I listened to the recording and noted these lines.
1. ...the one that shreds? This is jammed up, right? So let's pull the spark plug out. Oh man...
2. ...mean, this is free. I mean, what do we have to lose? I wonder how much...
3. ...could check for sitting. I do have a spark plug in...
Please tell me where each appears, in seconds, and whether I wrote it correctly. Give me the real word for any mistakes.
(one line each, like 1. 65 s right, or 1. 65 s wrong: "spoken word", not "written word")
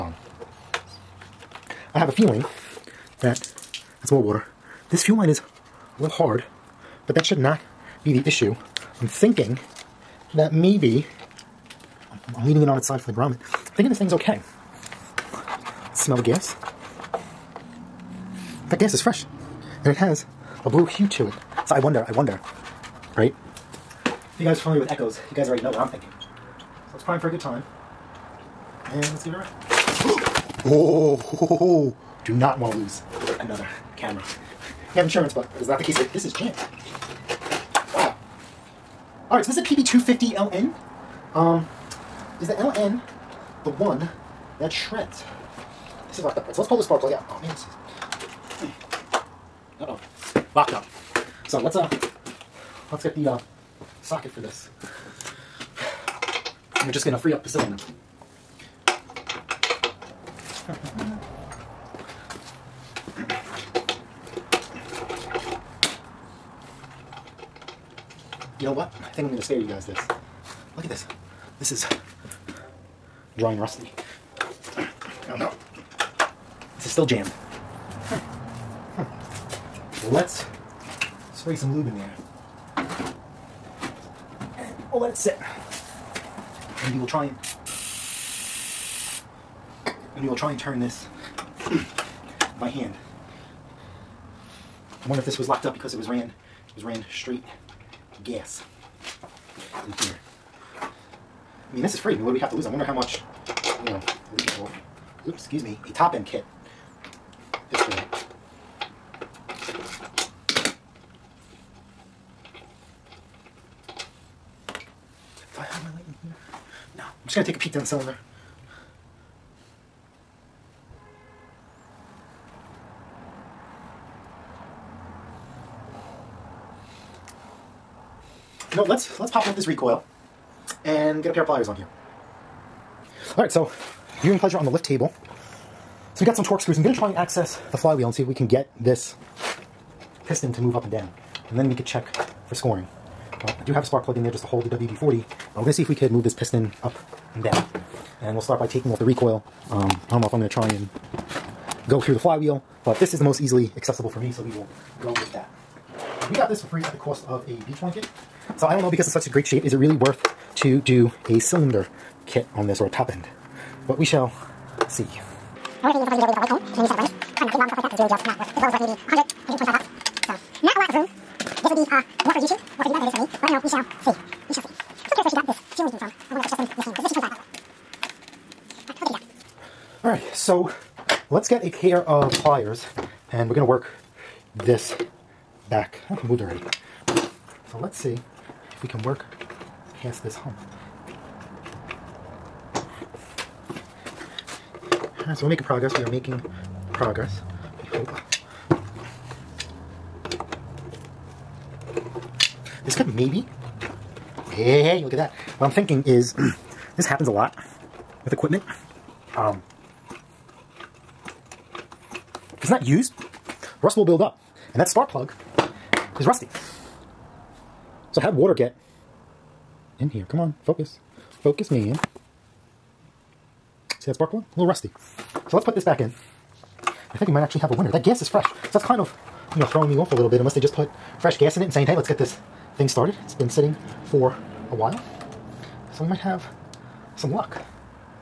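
1. 43 s wrong: "locked", not "jammed"
2. 101 s right
3. 141 s wrong: "scoring", not "sitting".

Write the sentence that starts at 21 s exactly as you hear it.
So I wonder, I wonder, right?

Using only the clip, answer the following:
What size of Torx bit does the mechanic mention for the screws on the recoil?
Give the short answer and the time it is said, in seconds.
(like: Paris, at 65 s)
T25, at 177 s.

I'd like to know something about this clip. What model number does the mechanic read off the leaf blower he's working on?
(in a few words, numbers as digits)
PB250LN.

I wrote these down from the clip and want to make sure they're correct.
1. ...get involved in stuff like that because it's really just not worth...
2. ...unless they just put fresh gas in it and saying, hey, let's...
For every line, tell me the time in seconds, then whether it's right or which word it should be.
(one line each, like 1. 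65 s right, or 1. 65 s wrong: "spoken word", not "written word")
1. 167 s right
2. 230 s right.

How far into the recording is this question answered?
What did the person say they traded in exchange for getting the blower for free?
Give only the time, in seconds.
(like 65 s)
157 s.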